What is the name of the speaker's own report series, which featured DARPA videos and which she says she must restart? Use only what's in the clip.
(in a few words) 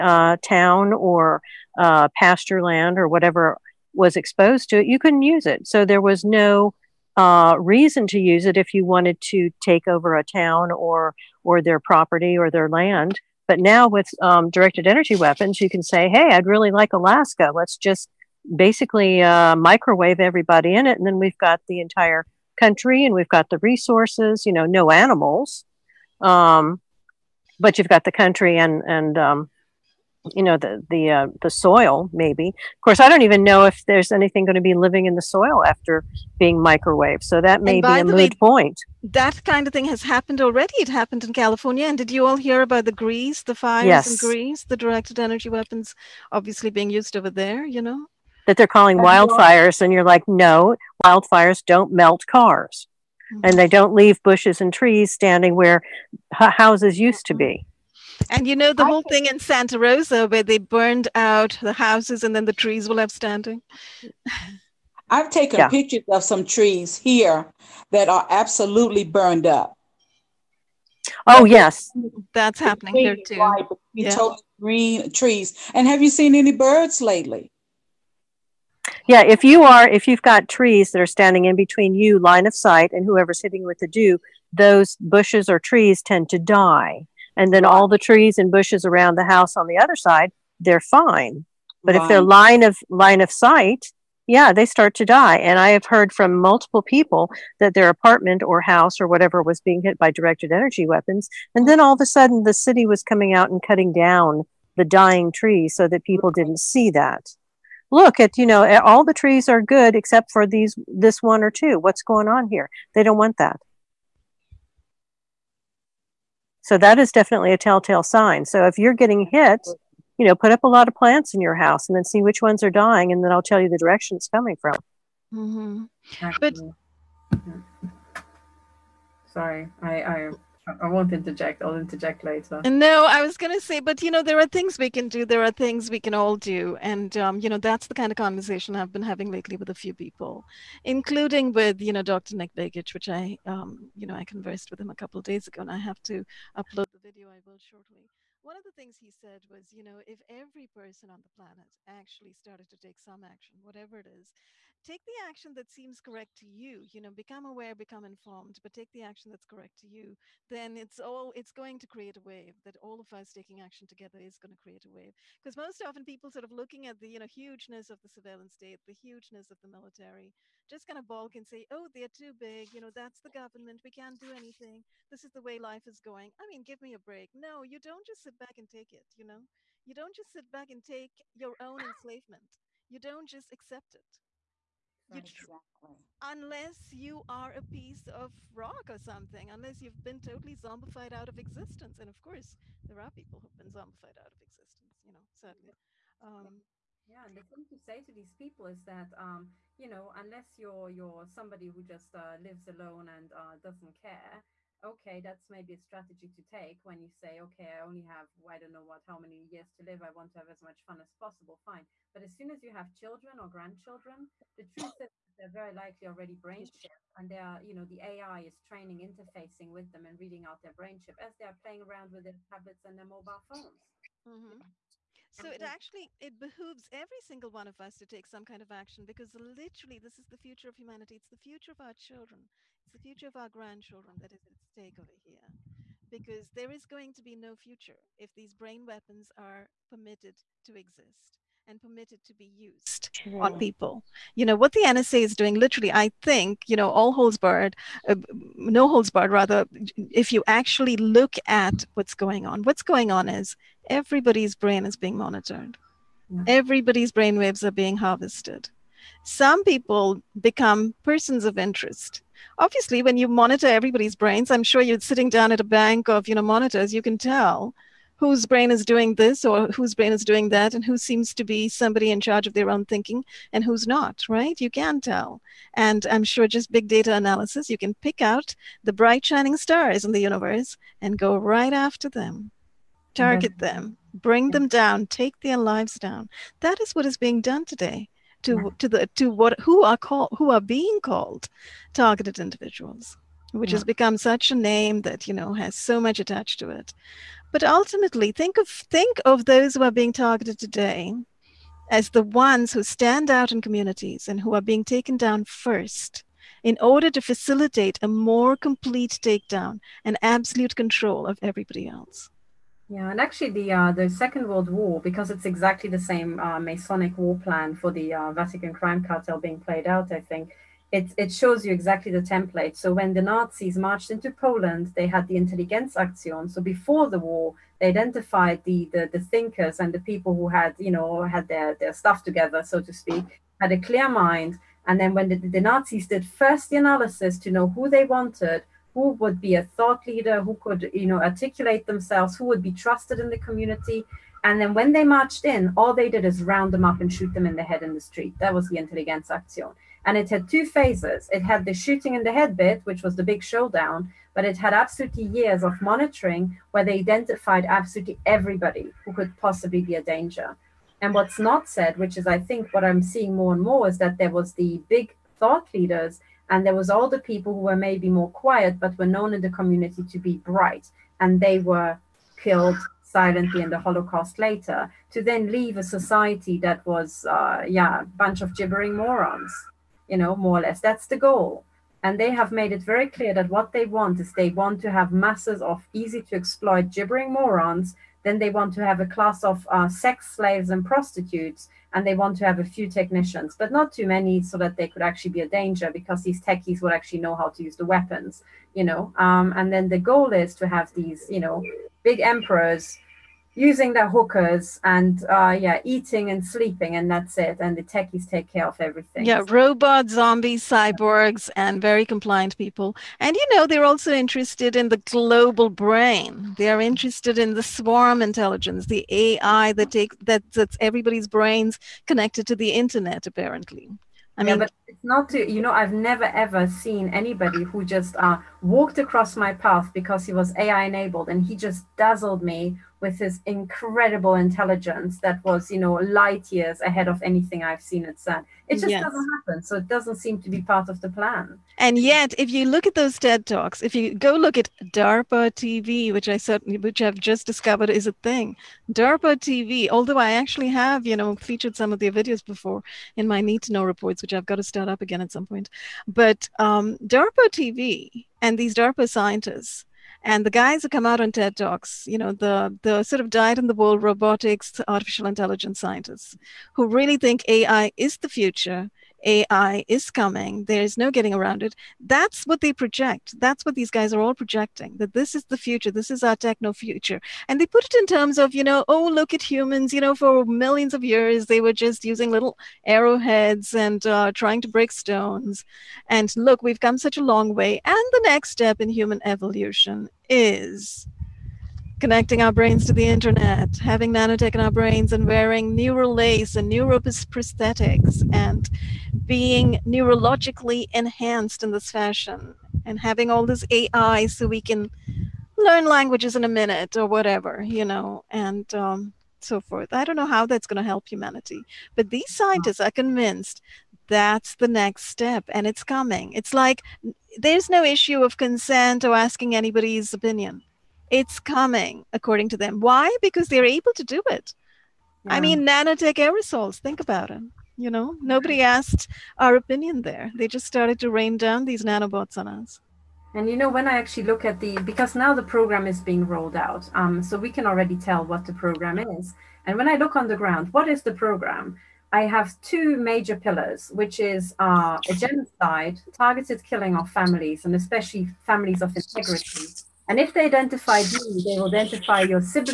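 Need to Know.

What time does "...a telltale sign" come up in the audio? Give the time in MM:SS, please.
01:57.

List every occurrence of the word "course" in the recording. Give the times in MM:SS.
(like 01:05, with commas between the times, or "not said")
00:32, 03:12.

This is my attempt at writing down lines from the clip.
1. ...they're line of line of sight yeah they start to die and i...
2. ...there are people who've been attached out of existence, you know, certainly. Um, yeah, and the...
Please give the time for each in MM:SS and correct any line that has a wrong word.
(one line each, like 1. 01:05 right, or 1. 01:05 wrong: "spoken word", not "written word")
1. 01:32 right
2. 03:12 wrong: "zombified", not "attached".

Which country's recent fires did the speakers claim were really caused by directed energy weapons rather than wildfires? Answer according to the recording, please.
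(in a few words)
Greece.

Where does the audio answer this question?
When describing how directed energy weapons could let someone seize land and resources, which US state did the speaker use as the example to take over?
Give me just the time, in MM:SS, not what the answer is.
00:16.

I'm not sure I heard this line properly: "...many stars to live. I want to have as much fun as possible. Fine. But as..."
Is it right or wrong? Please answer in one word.
wrong.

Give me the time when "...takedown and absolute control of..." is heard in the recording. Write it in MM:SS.
05:09.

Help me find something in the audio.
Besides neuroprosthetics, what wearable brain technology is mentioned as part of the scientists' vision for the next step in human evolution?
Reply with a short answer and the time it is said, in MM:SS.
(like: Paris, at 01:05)
neural lace, at 08:15.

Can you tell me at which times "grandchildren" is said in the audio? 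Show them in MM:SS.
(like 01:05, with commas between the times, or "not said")
03:33, 03:53.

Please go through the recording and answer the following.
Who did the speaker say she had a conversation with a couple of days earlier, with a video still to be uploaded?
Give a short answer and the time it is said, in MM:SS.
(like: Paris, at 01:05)
Dr. Nick Begich, at 02:22.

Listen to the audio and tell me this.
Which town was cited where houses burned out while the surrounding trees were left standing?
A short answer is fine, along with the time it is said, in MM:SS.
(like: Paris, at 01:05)
Santa Rosa, at 00:59.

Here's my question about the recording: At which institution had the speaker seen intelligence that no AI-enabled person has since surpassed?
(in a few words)
CERN.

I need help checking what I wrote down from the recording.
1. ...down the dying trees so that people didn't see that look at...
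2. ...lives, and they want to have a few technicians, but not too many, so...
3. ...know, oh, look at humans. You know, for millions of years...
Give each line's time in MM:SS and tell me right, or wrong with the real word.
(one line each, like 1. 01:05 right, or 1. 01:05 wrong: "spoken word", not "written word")
1. 01:43 right
2. 06:30 wrong: "prostitutes", not "lives"
3. 07:58 right.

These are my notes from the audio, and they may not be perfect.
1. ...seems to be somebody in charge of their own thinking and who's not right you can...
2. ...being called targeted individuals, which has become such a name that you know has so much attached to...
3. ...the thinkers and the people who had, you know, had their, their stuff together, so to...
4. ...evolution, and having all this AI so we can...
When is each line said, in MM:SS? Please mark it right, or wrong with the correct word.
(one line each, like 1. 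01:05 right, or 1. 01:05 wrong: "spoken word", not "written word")
1. 04:30 right
2. 04:50 right
3. 05:29 right
4. 08:21 wrong: "fashion", not "evolution".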